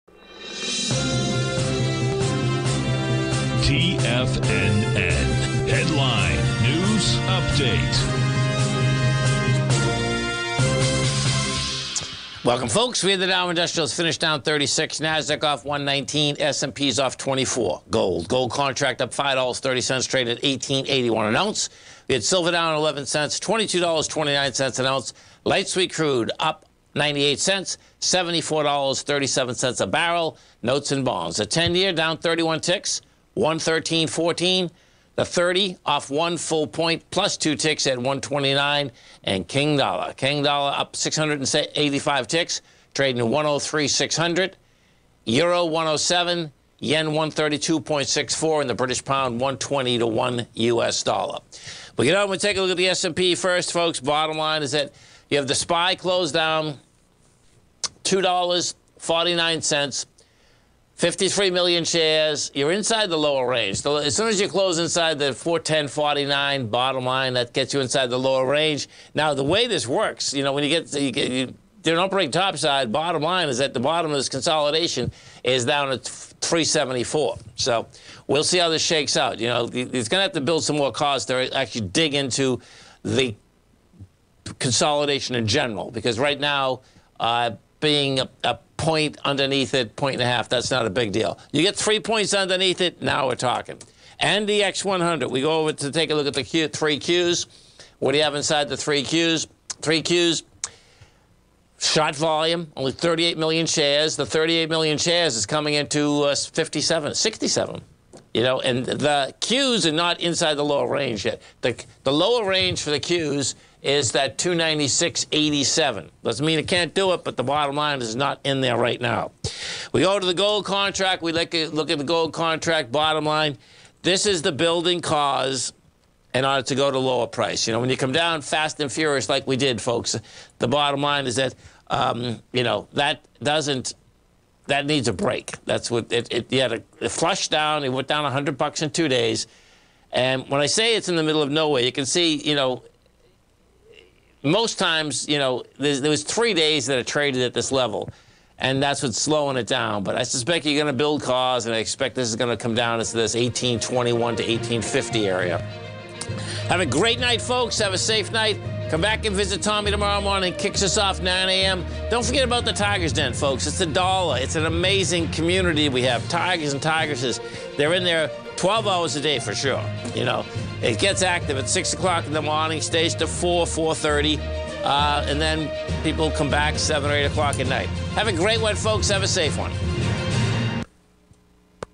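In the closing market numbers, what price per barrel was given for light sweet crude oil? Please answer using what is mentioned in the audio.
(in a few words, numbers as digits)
$74.37.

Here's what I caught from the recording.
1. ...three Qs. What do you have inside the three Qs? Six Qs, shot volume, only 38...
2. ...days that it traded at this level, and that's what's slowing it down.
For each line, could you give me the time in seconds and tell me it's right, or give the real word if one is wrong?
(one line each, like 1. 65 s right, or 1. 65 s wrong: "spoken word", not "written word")
1. 96 s wrong: "Three", not "Six"
2. 146 s right.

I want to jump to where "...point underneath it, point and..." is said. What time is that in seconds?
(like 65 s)
88 s.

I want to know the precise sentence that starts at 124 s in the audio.
This is the building cause in order to go to lower price.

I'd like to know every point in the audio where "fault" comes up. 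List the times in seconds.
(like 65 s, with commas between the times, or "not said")
not said.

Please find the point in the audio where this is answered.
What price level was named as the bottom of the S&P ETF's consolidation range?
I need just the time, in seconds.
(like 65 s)
76 s.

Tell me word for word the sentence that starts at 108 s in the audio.
You know, and the Qs are not inside the lower range yet.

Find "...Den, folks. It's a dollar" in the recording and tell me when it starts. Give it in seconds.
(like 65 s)
163 s.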